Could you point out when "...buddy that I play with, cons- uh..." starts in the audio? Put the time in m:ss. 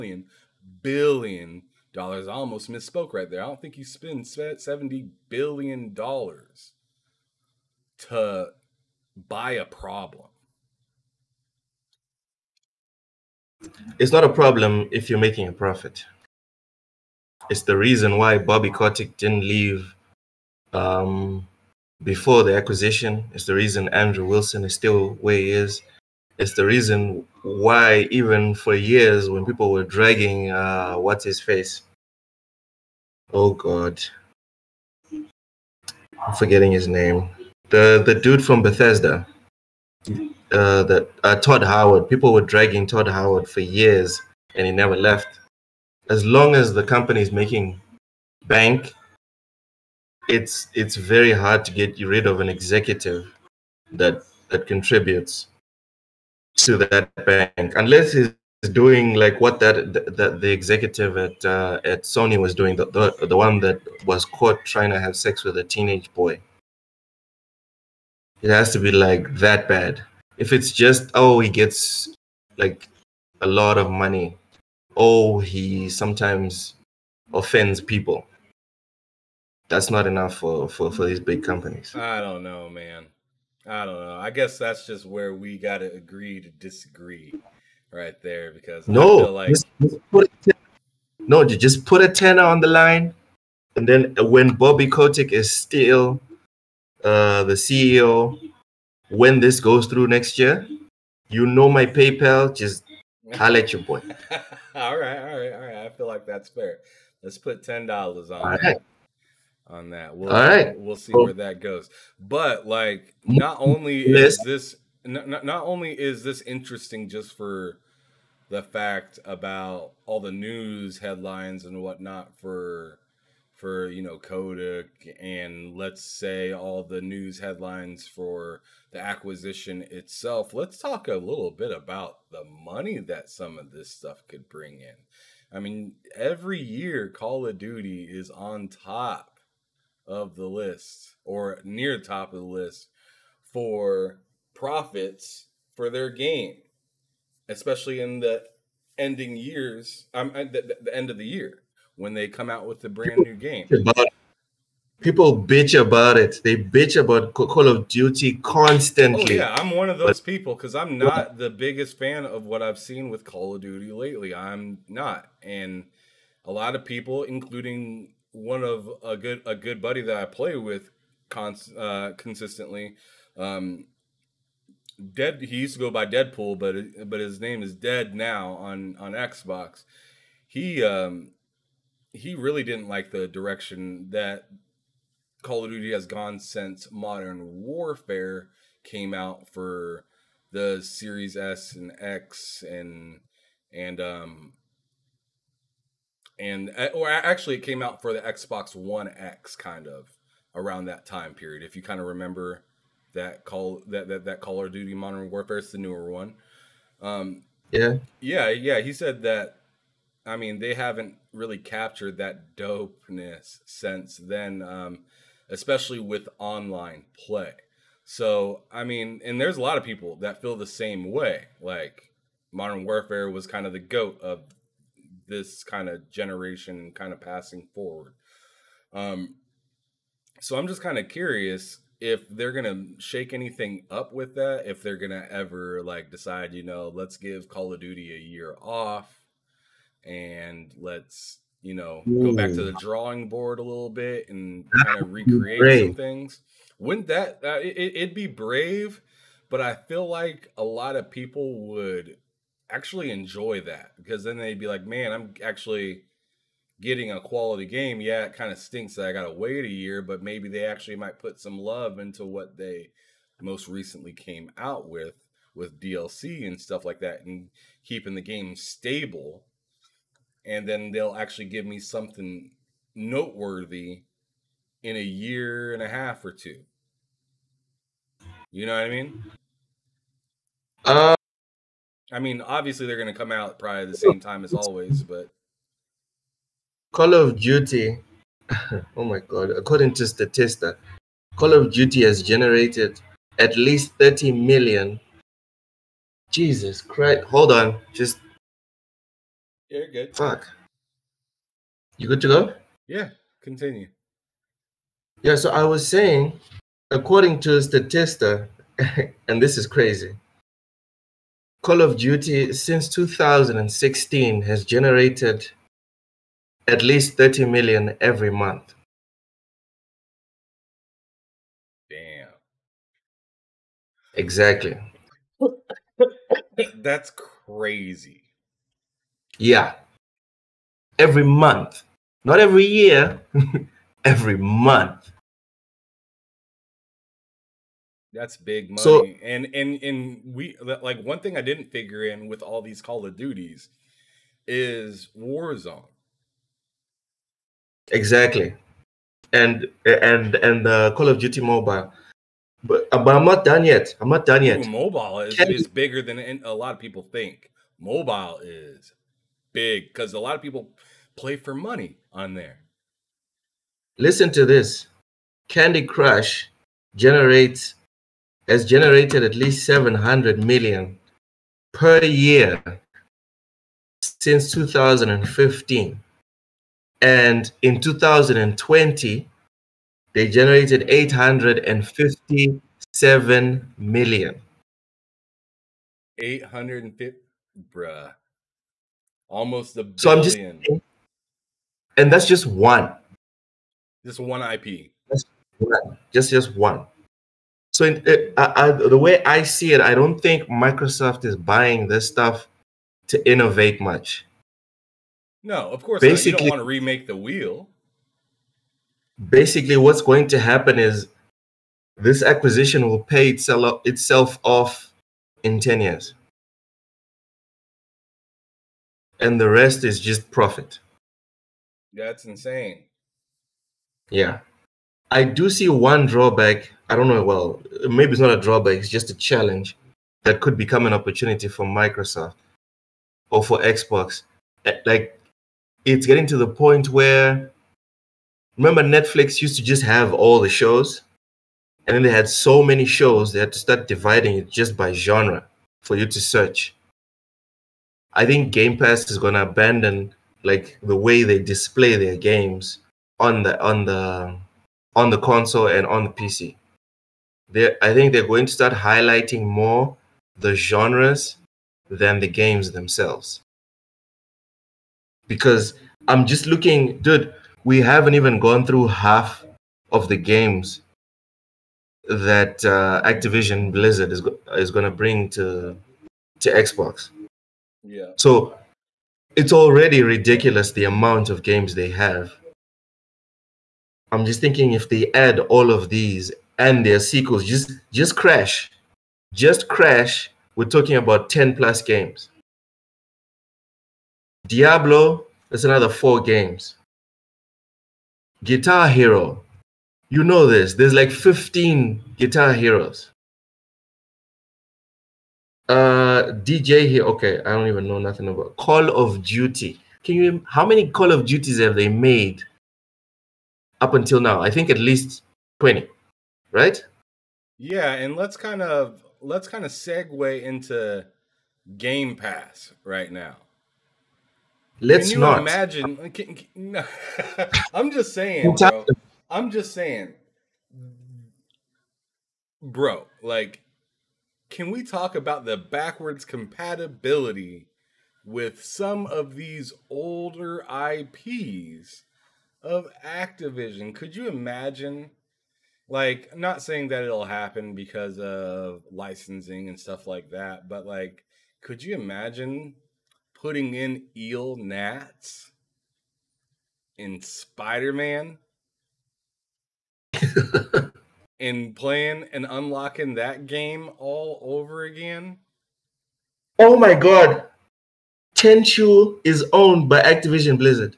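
2:49.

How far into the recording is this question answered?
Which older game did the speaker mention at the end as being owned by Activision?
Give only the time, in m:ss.
9:28.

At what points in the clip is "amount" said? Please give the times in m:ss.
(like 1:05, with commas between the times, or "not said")
8:00.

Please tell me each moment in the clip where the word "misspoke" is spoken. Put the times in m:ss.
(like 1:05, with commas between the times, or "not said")
0:02.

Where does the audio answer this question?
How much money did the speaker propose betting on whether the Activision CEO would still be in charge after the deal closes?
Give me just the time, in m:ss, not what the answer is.
1:32.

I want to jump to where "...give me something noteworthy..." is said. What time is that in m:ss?
4:31.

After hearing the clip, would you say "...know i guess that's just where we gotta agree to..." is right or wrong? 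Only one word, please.
right.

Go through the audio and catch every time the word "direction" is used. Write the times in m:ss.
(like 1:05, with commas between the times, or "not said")
3:03.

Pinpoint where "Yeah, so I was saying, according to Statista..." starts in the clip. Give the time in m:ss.
5:05.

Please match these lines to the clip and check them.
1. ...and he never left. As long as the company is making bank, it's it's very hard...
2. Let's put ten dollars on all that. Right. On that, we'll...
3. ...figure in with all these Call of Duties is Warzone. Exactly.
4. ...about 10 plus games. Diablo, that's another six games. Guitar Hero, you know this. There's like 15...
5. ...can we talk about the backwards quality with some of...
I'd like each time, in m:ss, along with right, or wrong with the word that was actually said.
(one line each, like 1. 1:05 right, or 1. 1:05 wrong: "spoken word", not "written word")
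1. 0:44 right
2. 1:47 right
3. 5:41 right
4. 8:10 wrong: "four", not "six"
5. 8:54 wrong: "compatibility", not "quality".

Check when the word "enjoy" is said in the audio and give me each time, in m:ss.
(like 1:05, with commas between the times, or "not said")
4:13.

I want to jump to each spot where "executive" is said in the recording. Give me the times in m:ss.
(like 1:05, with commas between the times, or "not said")
0:52, 1:00.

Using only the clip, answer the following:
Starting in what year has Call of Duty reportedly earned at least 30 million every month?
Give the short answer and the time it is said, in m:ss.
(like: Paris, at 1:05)
2016, at 5:12.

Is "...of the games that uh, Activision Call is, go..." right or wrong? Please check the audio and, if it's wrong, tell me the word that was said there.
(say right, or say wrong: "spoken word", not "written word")
wrong: "Blizzard", not "Call".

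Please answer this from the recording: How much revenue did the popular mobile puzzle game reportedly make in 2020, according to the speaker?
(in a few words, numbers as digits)
857 million.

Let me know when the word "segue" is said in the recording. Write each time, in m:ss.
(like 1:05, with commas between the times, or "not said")
8:39.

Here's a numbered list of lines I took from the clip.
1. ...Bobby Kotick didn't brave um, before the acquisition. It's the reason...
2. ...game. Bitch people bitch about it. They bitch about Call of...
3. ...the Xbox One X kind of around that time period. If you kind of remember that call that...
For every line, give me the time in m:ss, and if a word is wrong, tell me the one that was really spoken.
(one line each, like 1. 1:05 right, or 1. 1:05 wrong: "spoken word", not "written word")
1. 0:18 wrong: "leave", not "brave"
2. 2:33 right
3. 3:18 right.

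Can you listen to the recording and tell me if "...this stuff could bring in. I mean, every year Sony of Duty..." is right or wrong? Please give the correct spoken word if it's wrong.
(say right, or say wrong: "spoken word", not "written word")
wrong: "Call", not "Sony".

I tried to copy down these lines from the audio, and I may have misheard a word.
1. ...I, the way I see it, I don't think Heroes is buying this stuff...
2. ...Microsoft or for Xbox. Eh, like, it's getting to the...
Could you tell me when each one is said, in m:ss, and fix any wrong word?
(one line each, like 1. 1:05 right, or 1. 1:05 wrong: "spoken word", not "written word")
1. 6:38 wrong: "Microsoft", not "Heroes"
2. 7:11 right.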